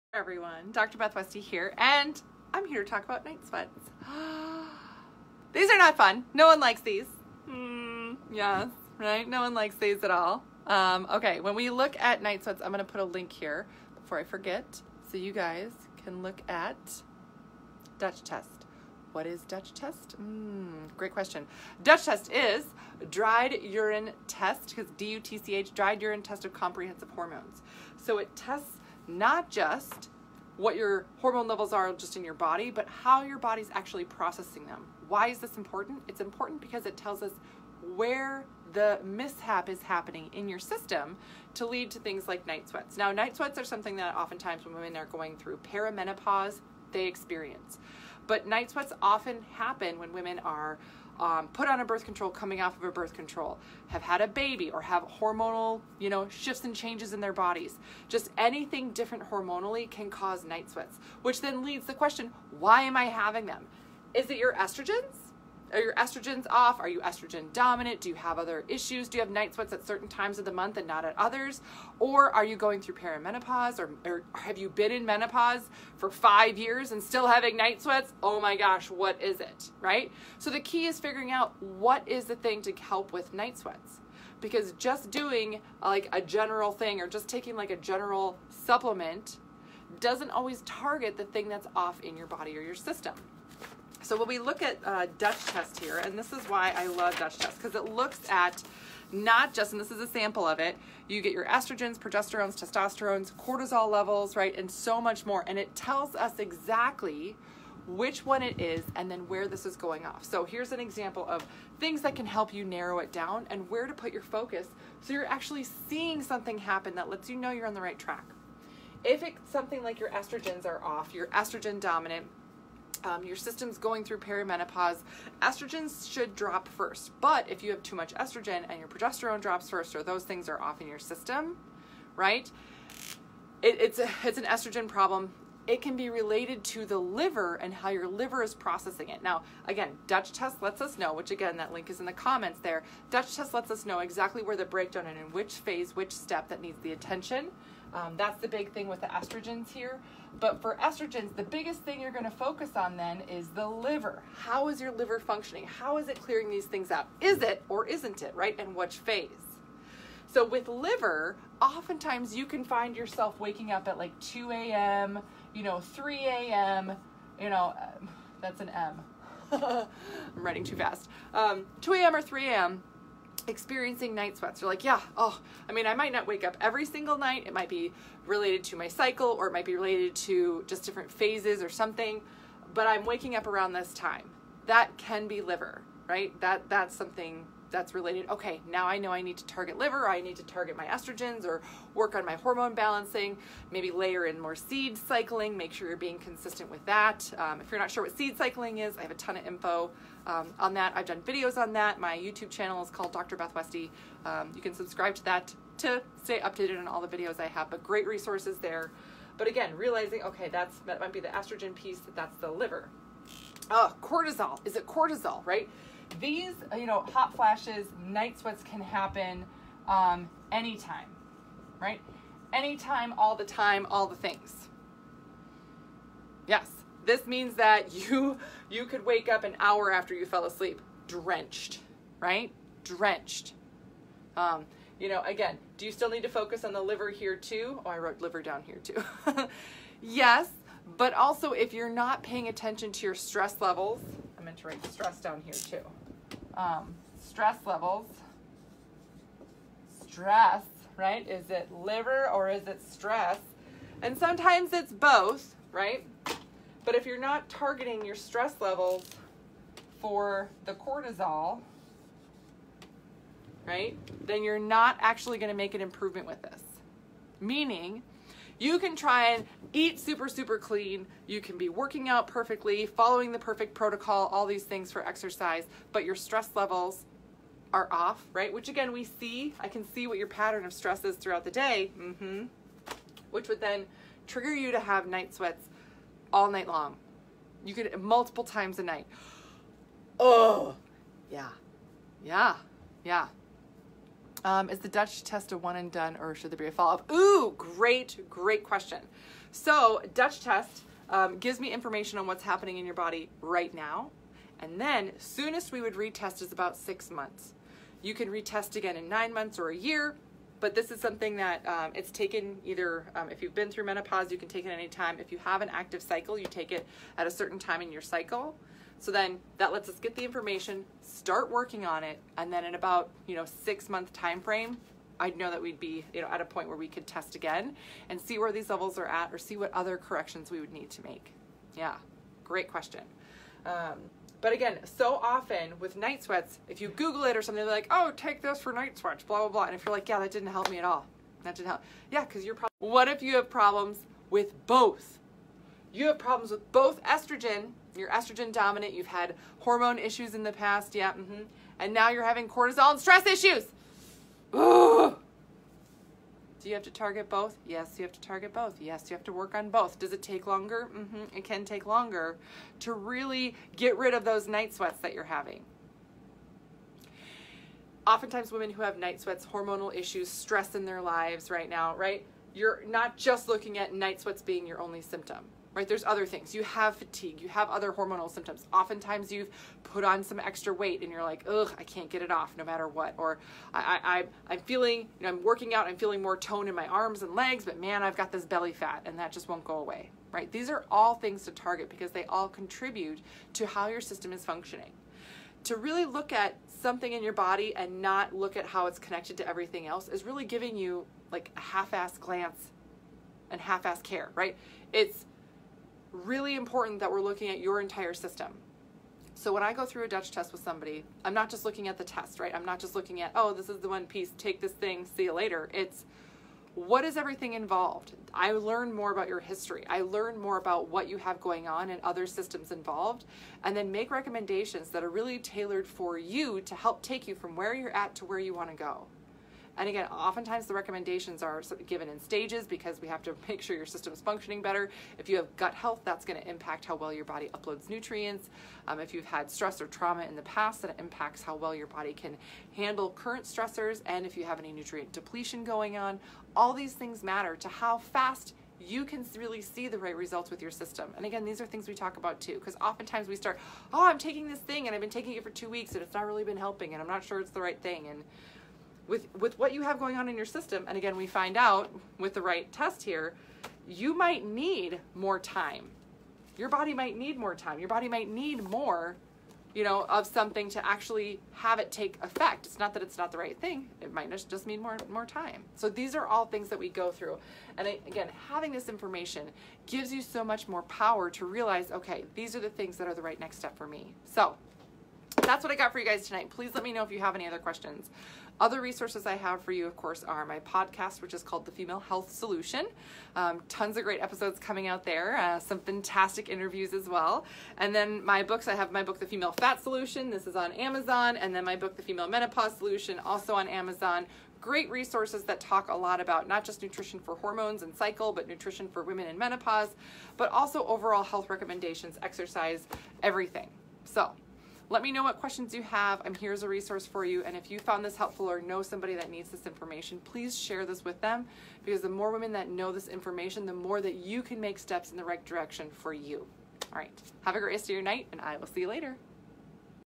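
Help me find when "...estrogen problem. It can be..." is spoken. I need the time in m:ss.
2:14.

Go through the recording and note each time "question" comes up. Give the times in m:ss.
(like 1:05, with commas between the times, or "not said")
0:21, 1:01, 4:58, 5:32, 8:07, 8:35.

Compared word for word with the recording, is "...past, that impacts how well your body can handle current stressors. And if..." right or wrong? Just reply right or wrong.
right.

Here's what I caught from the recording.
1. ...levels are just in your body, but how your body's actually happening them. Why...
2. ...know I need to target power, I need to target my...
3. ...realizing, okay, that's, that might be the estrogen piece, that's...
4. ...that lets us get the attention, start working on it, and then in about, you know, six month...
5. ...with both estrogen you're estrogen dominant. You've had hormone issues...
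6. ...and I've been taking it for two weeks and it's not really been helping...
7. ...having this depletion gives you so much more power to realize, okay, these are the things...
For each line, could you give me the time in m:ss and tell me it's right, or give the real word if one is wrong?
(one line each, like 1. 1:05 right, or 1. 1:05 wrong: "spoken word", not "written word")
1. 0:31 wrong: "processing", not "happening"
2. 3:08 wrong: "liver", not "power"
3. 3:29 right
4. 5:19 wrong: "information", not "attention"
5. 5:46 right
6. 7:34 right
7. 7:58 wrong: "information", not "depletion".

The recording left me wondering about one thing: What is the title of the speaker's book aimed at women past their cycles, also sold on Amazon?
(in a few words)
The Female Menopause Solution.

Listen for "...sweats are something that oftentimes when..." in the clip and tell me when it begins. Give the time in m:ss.
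0:43.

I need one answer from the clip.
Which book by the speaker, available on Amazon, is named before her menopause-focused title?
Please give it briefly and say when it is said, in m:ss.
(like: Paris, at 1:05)
The Female Fat Solution, at 8:19.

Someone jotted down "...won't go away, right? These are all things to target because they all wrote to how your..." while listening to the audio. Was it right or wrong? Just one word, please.
wrong.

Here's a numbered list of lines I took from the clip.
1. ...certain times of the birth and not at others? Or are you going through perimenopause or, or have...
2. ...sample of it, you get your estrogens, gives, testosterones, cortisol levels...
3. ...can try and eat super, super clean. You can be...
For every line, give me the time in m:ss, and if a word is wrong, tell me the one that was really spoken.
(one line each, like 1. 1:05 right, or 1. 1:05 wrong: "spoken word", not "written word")
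1. 1:09 wrong: "month", not "birth"
2. 1:40 wrong: "progesterones", not "gives"
3. 4:28 right.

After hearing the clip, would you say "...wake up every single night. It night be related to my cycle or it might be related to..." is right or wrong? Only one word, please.
wrong.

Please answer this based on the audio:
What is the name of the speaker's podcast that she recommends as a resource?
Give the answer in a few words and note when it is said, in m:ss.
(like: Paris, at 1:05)
The Female Health Solution, at 8:11.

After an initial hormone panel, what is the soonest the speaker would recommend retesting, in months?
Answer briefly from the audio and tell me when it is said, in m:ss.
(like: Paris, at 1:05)
6 months, at 5:06.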